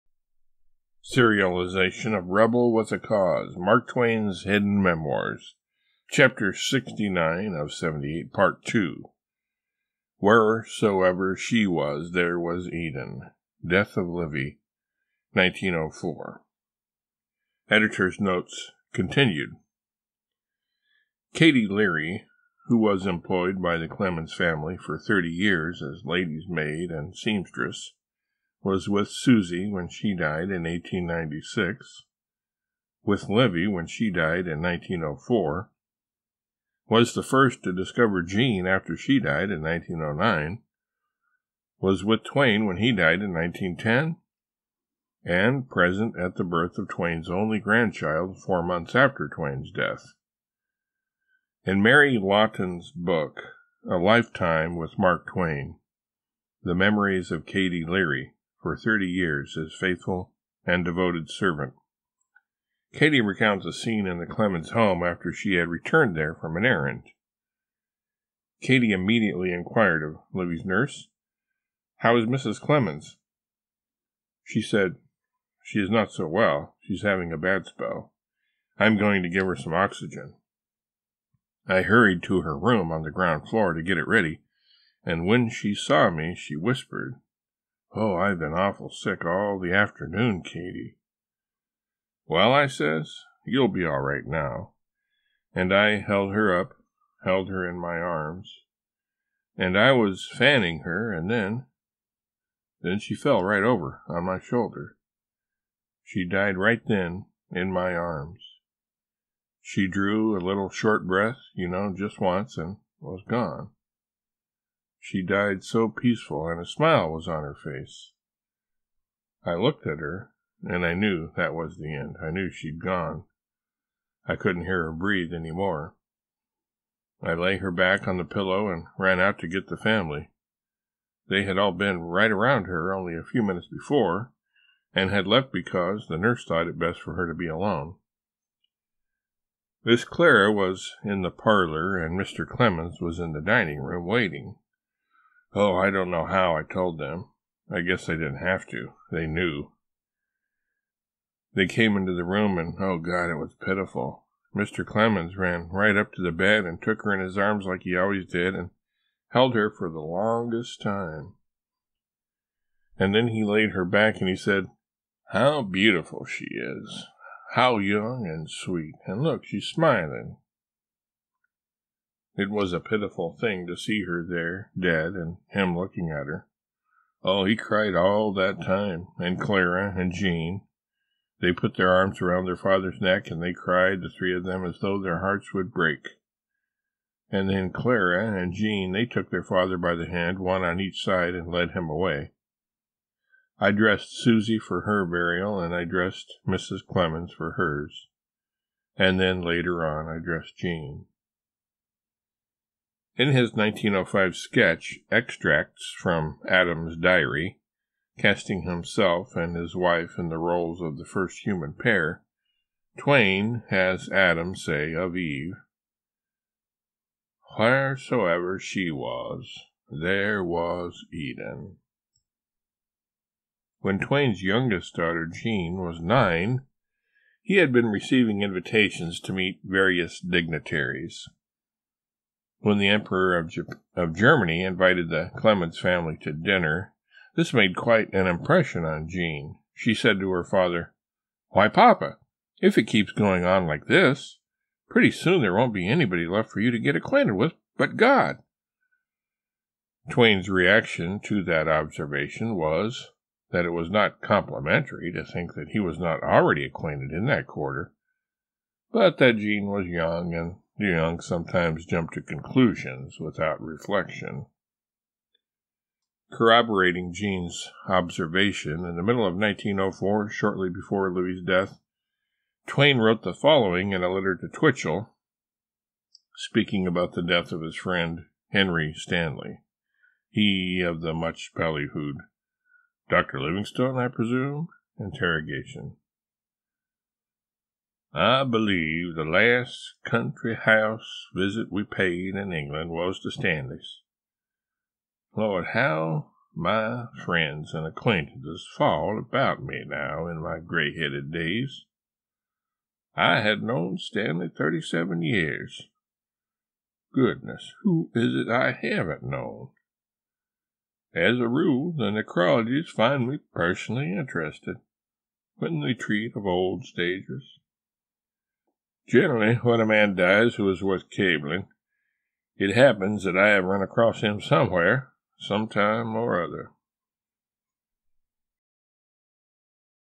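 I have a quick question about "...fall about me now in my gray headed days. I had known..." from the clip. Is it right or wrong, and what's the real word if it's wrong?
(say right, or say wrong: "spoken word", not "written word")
right.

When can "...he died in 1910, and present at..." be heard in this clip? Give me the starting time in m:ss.
0:42.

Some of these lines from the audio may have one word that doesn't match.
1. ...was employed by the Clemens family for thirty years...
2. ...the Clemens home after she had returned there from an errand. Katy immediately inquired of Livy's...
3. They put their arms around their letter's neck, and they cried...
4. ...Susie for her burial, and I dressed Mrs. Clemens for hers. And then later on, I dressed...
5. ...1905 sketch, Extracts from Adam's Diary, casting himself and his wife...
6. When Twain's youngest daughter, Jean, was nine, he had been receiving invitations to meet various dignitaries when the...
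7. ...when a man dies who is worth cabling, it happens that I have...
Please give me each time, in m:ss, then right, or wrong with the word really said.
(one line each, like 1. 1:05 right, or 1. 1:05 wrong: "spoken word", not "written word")
1. 0:22 right
2. 1:04 right
3. 3:01 wrong: "father", not "letter"
4. 3:14 right
5. 3:23 right
6. 3:43 right
7. 5:19 right.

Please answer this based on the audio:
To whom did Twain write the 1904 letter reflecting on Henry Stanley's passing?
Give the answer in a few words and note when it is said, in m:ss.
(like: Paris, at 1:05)
Twichell, at 4:34.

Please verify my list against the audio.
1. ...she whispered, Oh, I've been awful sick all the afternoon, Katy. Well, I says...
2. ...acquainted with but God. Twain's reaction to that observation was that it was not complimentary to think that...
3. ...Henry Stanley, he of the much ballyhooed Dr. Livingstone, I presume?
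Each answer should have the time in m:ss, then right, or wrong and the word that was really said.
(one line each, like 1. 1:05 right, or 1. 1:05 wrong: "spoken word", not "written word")
1. 1:26 right
2. 4:06 right
3. 4:38 right.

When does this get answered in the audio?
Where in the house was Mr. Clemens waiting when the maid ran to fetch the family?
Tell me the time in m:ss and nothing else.
2:23.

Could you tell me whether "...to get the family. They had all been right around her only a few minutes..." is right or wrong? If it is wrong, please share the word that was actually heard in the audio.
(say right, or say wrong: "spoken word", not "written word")
right.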